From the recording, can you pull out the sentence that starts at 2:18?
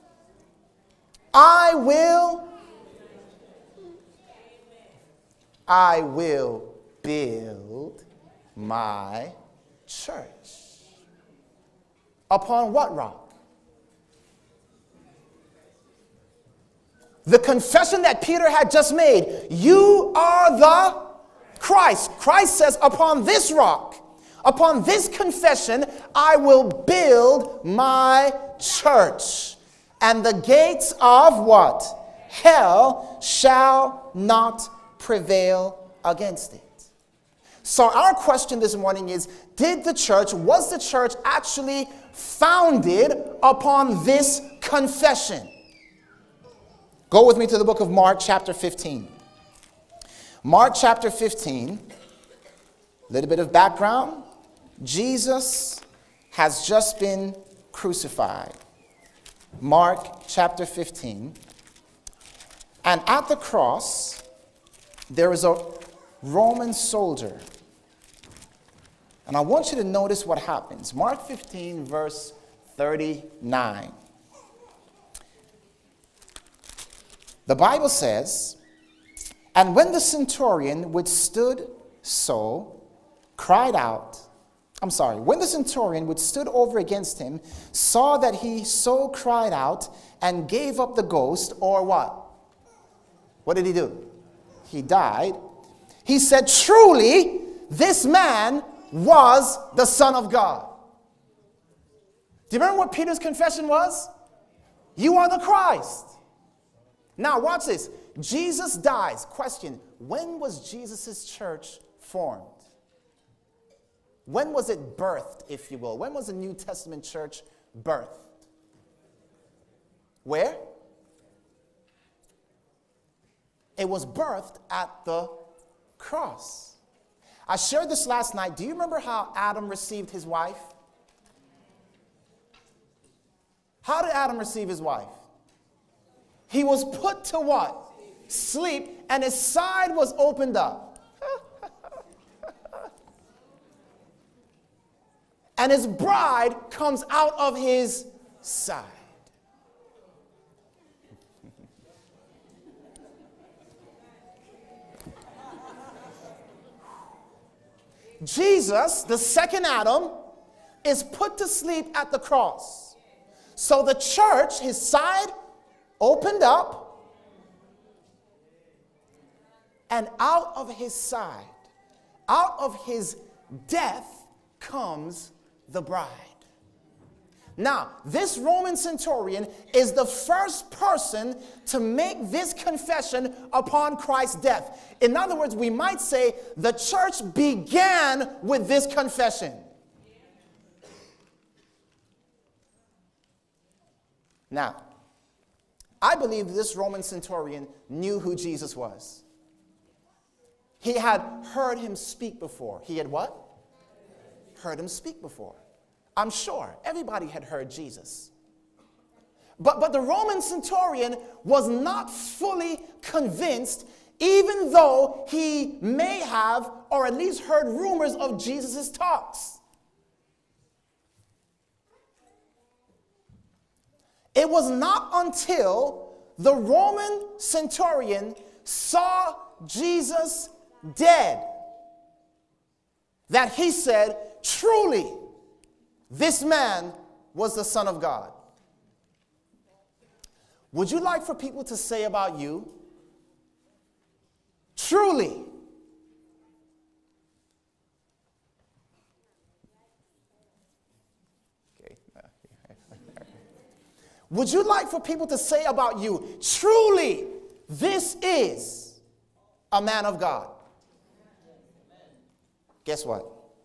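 Sleep, and his side was opened up.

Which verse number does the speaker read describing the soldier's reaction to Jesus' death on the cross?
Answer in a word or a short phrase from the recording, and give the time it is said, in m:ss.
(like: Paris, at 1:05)
39, at 1:12.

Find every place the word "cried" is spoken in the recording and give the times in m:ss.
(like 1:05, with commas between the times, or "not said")
1:23, 1:29.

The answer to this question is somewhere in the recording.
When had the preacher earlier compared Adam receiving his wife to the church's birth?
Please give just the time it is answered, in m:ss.
2:08.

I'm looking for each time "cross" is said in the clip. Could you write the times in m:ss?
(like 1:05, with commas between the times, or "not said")
1:03, 2:05, 2:42.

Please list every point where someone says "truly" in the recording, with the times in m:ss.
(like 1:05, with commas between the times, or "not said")
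1:36, 3:54, 4:04, 4:16.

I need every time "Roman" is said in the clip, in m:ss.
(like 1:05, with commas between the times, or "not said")
1:06, 2:58, 3:16, 3:30, 3:46.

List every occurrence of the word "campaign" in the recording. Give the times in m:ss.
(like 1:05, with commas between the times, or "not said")
not said.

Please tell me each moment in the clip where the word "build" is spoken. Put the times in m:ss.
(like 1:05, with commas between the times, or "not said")
0:07, 0:26.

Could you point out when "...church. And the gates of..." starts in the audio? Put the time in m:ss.
0:28.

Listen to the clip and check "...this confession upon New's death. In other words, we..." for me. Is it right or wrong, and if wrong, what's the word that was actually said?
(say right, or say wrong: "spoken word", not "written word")
wrong: "Christ", not "New".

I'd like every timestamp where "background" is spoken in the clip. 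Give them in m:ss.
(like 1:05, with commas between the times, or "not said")
0:53.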